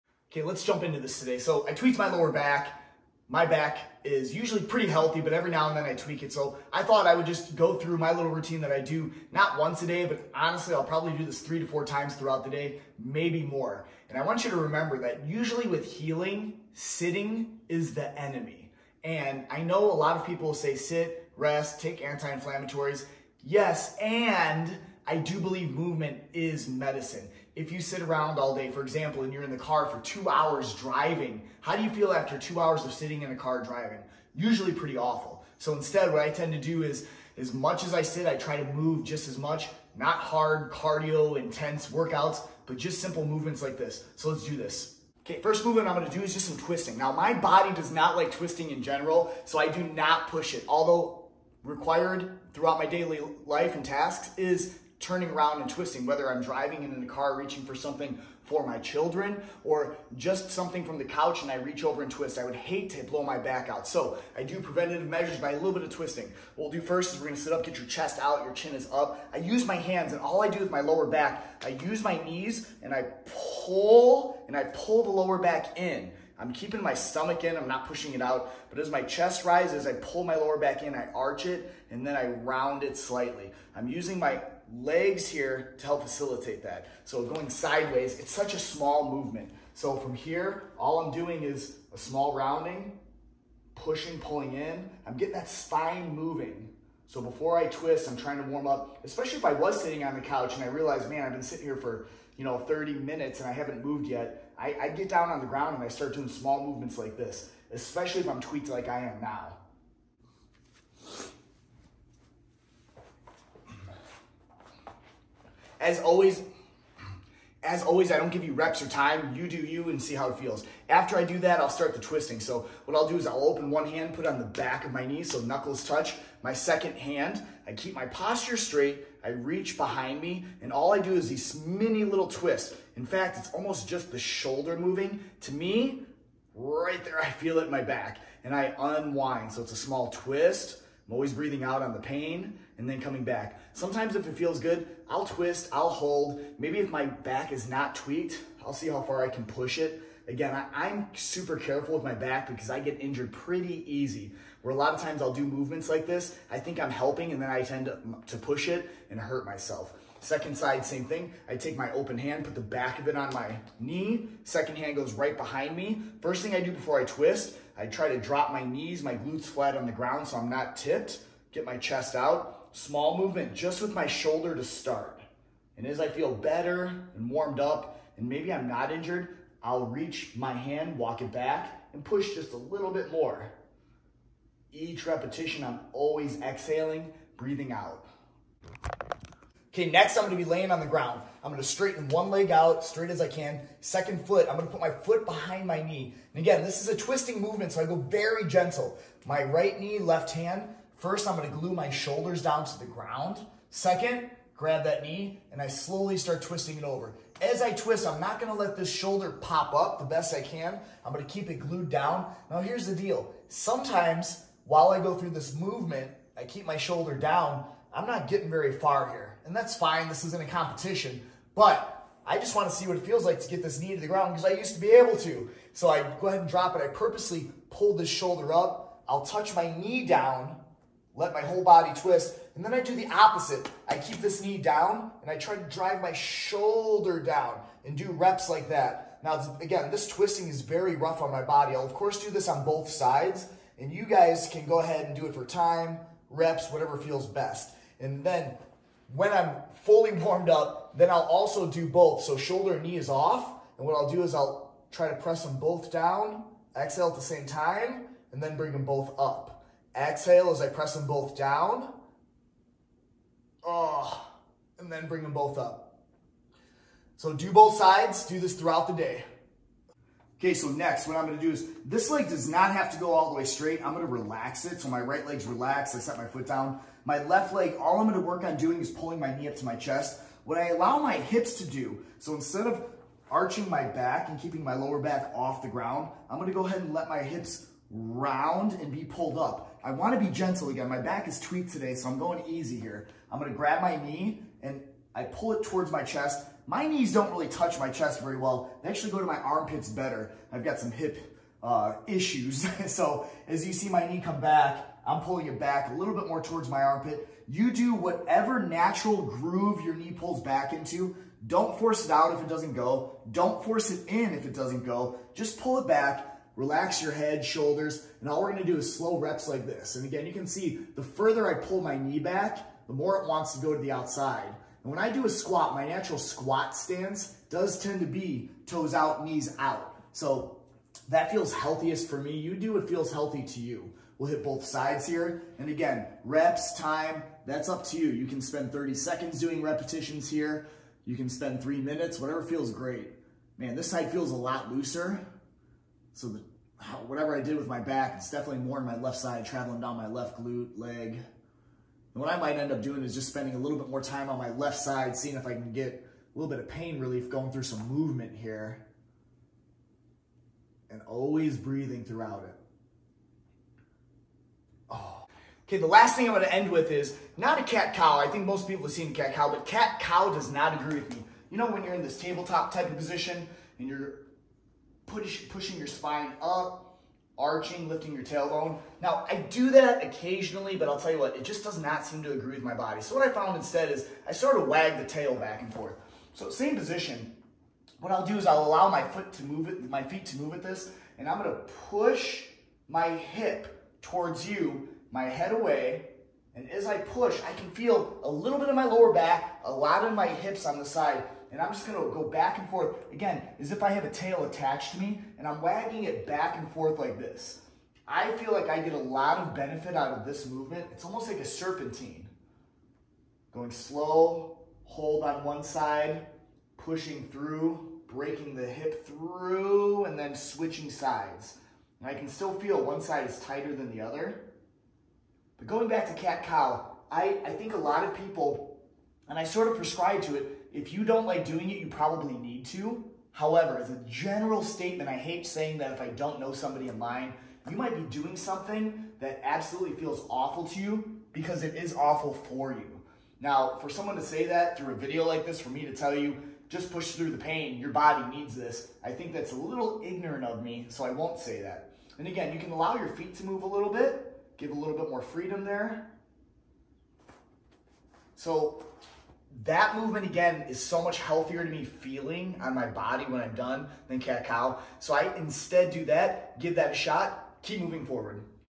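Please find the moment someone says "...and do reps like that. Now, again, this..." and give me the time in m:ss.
3:57.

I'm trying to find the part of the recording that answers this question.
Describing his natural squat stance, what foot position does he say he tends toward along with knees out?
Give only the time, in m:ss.
5:28.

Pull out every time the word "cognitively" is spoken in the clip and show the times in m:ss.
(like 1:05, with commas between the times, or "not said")
not said.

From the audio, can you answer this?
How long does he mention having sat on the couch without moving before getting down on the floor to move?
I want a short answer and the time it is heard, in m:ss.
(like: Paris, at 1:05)
30 minutes, at 1:42.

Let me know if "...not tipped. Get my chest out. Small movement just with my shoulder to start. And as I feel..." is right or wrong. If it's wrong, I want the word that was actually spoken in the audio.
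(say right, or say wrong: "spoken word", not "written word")
right.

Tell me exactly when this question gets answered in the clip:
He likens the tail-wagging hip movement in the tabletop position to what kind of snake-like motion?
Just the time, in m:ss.
6:51.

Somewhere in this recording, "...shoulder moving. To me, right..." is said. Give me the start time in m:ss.
2:14.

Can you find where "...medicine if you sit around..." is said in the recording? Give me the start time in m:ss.
0:26.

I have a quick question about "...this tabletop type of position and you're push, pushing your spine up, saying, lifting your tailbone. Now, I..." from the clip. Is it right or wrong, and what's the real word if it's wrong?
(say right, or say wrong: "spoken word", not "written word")
wrong: "arching", not "saying".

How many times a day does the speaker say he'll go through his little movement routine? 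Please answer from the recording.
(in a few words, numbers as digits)
3 to 4.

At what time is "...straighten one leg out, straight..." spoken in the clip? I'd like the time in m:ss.
3:11.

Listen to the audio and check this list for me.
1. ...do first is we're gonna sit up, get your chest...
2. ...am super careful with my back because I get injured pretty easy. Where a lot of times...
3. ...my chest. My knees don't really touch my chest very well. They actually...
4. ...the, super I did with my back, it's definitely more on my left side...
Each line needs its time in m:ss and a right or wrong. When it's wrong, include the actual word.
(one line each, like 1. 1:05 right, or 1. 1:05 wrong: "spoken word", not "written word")
1. 1:06 right
2. 2:30 right
3. 4:55 right
4. 5:46 wrong: "whatever", not "super".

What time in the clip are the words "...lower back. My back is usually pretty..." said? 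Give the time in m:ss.
0:02.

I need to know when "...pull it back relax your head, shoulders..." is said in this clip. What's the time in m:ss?
5:15.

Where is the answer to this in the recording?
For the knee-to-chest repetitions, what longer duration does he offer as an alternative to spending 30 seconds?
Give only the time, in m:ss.
5:41.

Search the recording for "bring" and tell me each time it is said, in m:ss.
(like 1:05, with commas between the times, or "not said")
4:18, 4:25.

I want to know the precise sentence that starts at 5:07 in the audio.
You do whatever natural groove your knee pulls back into.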